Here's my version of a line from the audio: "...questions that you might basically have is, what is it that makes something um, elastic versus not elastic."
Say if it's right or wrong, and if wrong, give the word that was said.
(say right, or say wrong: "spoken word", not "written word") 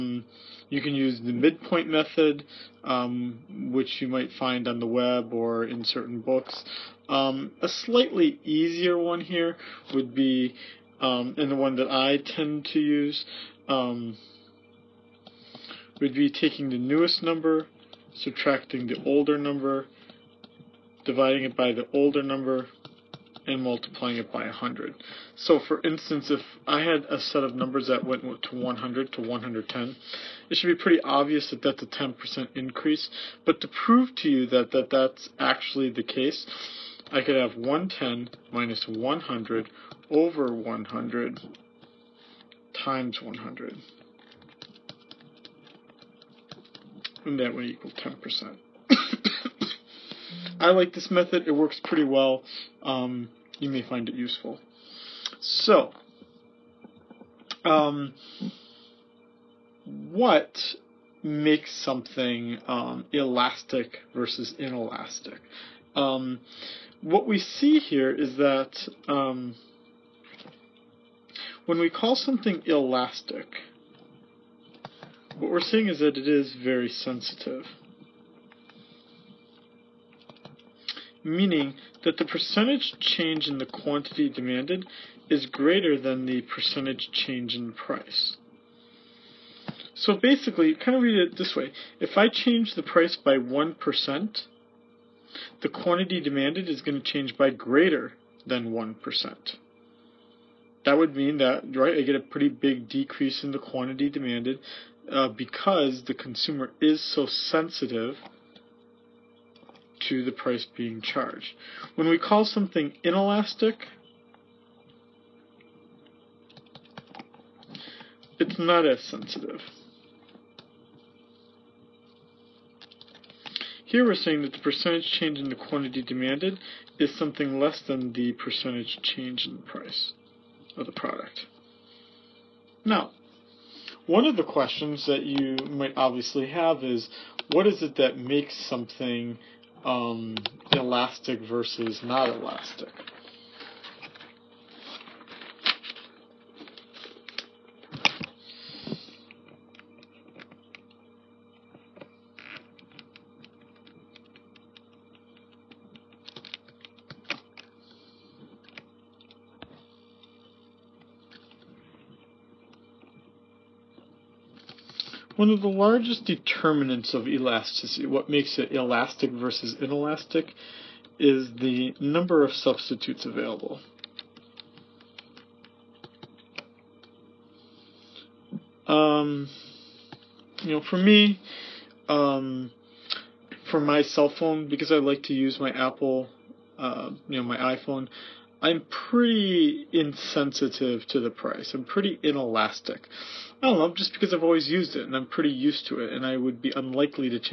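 wrong: "obviously", not "basically".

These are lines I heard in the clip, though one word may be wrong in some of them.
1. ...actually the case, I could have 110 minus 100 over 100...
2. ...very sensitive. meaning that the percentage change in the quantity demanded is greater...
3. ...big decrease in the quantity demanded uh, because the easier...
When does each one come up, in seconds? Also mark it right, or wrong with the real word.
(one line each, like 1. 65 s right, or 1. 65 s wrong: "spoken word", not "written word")
1. 35 s right
2. 76 s right
3. 102 s wrong: "consumer", not "easier".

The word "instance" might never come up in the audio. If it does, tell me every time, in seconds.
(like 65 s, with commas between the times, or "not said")
25 s.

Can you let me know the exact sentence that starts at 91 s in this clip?
If I change the price by 1%, the quantity demanded is going to change by greater than 1%.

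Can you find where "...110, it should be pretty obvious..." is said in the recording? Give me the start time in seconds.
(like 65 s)
29 s.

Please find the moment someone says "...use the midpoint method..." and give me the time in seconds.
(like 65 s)
0 s.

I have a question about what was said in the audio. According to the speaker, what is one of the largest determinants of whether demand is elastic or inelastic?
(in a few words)
number of substitutes.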